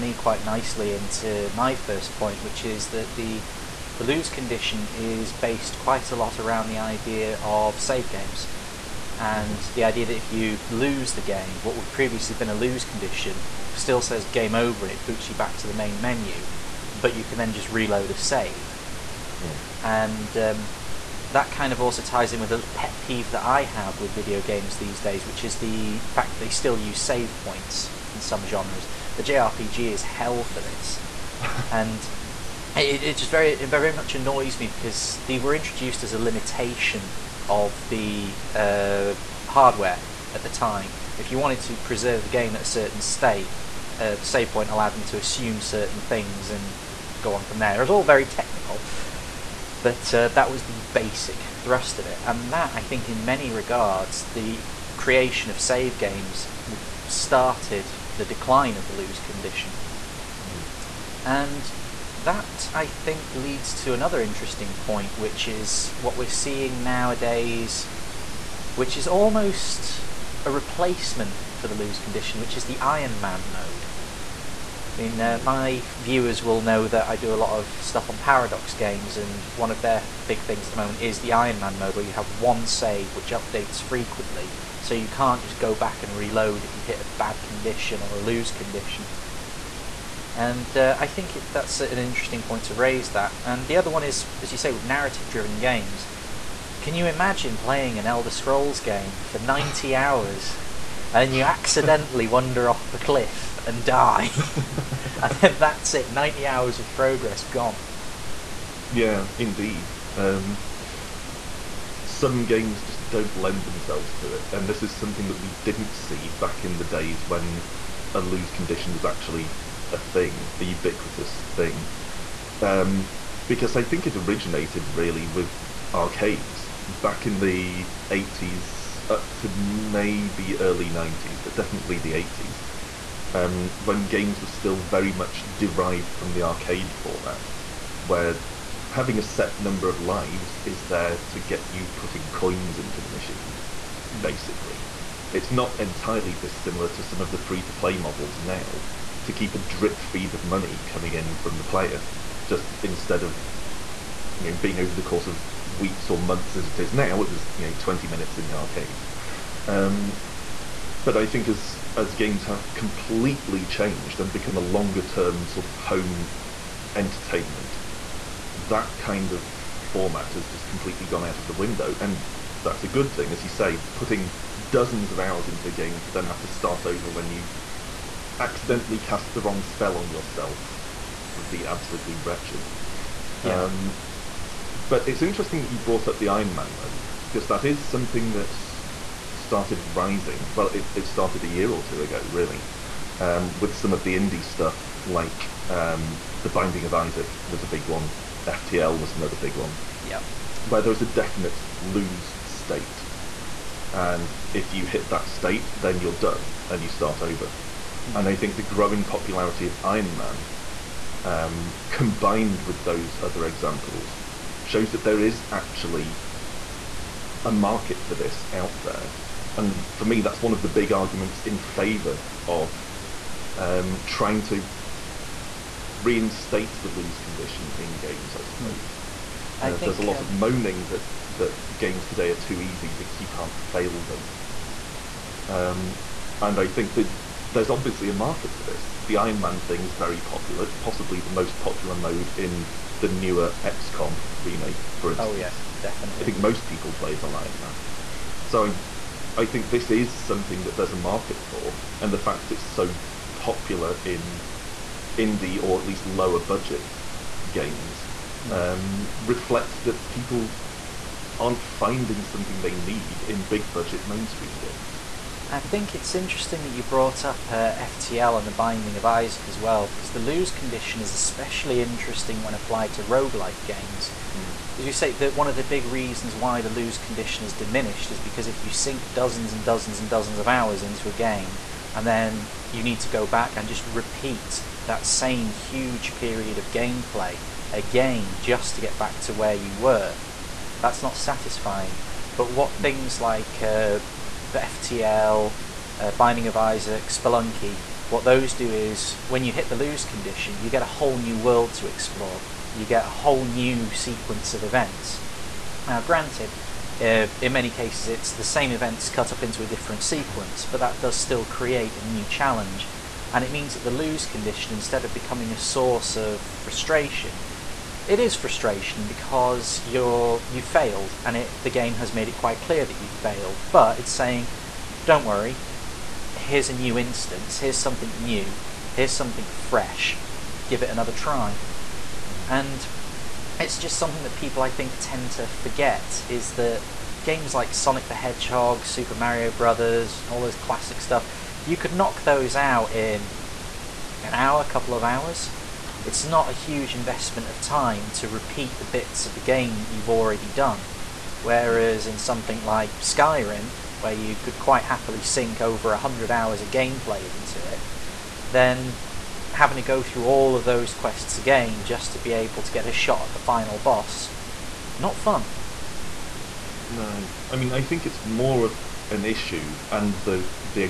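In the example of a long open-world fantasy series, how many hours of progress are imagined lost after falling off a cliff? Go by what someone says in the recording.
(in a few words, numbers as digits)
90.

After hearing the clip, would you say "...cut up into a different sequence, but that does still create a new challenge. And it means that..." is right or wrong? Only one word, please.
right.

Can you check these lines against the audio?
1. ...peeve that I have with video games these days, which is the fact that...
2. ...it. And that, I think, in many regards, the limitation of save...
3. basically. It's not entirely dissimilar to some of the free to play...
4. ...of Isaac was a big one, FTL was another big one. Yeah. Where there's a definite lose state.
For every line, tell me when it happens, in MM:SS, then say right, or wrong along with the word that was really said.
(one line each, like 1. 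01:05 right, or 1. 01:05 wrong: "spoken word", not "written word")
1. 00:22 right
2. 00:52 wrong: "creation", not "limitation"
3. 02:24 right
4. 03:16 right.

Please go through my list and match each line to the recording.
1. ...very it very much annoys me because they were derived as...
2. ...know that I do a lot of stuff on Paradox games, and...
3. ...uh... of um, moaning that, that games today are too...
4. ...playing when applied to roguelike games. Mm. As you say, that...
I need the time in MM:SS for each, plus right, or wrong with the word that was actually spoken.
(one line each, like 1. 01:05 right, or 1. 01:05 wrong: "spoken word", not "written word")
1. 00:33 wrong: "introduced", not "derived"
2. 01:16 right
3. 03:50 right
4. 04:31 wrong: "interesting", not "playing".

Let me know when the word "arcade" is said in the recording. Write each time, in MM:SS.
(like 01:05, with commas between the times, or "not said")
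02:05, 02:16, 02:38.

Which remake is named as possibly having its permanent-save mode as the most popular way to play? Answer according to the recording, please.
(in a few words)
XCOM.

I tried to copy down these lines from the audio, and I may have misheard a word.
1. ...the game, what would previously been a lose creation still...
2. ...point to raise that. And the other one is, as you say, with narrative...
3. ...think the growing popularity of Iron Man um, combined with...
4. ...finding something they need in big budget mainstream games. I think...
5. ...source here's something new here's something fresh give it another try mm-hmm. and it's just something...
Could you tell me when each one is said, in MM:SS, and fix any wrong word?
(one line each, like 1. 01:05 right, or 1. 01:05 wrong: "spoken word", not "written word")
1. 00:11 wrong: "condition", not "creation"
2. 01:32 right
3. 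03:28 right
4. 04:21 right
5. 05:26 wrong: "instance", not "source".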